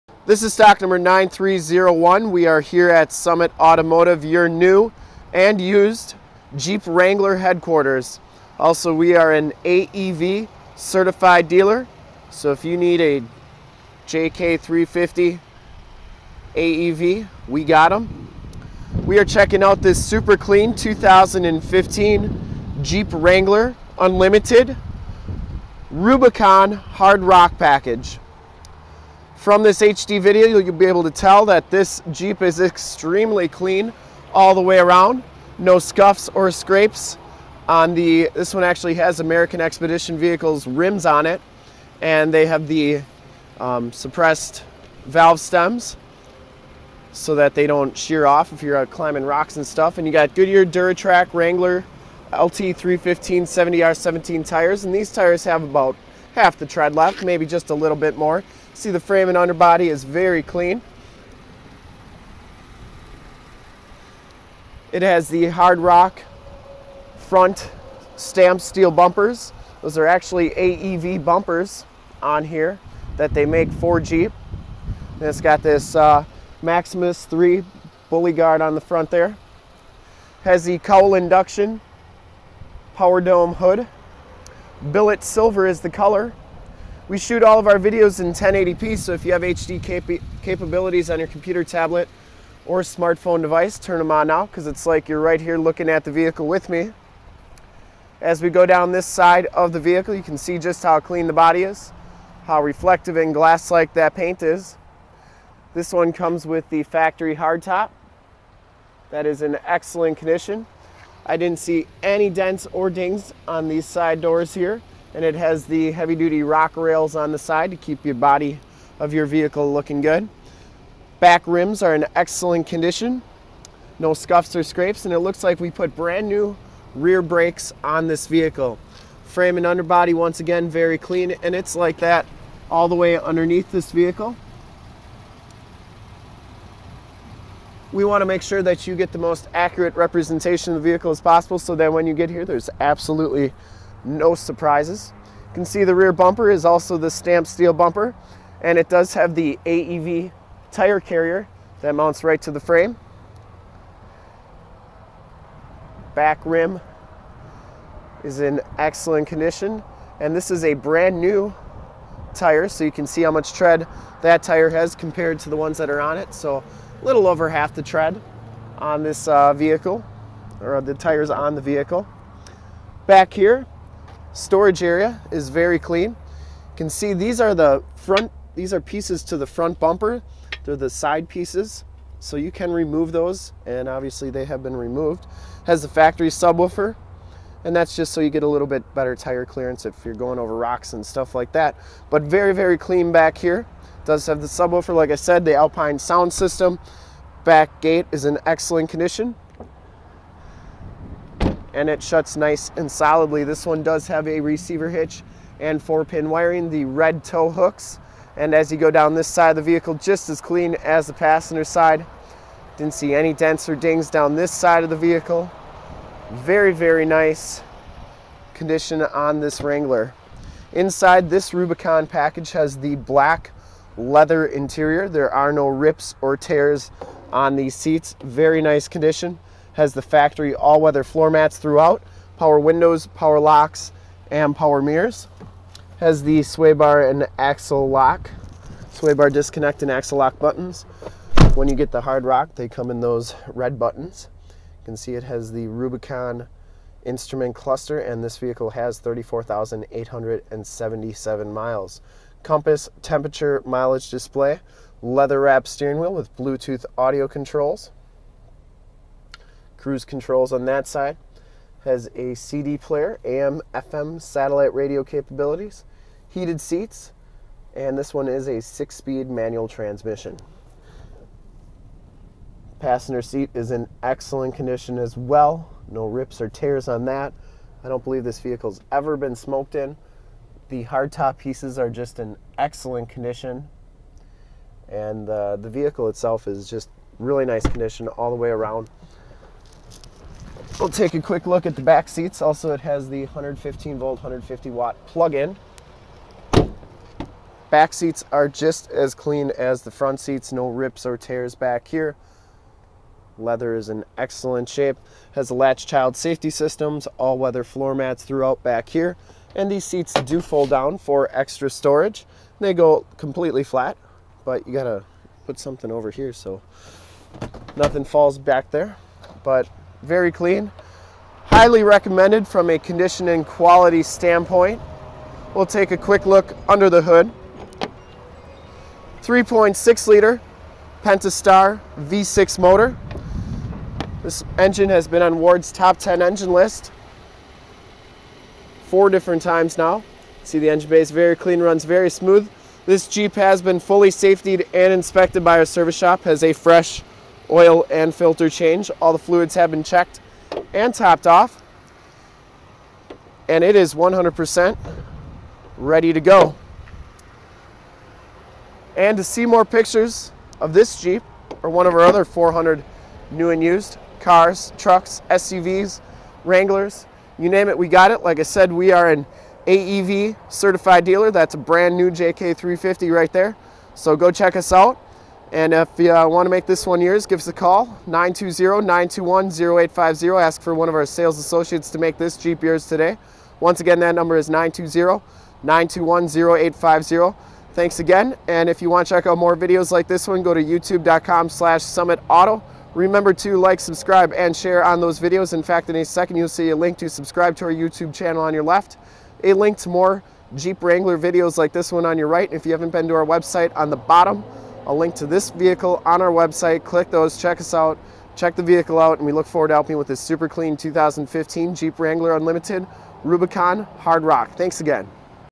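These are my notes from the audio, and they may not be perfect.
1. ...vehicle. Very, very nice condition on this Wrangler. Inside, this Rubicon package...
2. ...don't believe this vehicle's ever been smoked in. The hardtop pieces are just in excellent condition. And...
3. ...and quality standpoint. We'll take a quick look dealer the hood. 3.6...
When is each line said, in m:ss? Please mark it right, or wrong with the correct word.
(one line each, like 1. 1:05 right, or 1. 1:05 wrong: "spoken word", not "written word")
1. 3:34 right
2. 4:37 right
3. 5:23 wrong: "under", not "dealer".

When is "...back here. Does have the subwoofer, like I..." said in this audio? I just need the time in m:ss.
3:13.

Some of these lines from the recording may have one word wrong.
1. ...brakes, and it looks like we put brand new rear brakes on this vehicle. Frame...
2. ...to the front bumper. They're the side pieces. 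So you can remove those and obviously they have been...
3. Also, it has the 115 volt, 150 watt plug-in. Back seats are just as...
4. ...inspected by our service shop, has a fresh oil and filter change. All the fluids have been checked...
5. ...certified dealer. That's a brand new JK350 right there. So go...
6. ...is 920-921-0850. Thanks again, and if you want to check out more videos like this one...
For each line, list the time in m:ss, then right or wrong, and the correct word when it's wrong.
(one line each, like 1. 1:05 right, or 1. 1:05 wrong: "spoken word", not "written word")
1. 2:04 wrong: "scrapes", not "brakes"
2. 2:59 right
3. 4:52 right
4. 5:44 right
5. 6:10 right
6. 6:24 right.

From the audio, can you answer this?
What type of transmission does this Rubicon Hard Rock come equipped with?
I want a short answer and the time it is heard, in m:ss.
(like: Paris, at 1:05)
six speed manual, at 4:28.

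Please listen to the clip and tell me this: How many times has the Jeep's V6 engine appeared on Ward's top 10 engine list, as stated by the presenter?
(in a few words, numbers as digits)
4.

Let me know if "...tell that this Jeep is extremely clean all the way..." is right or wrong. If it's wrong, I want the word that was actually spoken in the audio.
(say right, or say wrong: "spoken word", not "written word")
right.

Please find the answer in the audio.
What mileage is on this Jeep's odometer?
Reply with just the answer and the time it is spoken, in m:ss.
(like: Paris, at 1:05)
34,877 miles, at 4:08.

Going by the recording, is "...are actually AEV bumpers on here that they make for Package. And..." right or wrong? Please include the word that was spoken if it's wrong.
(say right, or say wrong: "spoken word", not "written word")
wrong: "Jeep", not "Package".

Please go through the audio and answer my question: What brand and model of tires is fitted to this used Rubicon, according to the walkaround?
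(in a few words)
Goodyear Duratrac.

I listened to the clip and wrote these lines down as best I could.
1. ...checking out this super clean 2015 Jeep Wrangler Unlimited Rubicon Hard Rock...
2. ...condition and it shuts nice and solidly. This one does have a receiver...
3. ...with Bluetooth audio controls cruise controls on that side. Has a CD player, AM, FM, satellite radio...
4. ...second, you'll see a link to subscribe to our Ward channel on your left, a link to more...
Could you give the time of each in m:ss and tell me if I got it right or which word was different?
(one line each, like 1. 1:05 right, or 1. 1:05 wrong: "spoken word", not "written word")
1. 0:19 right
2. 3:18 right
3. 4:16 right
4. 6:36 wrong: "YouTube", not "Ward".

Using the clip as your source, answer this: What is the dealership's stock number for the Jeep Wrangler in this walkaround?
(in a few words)
9301.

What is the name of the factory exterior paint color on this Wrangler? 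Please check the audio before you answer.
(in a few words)
Billet silver.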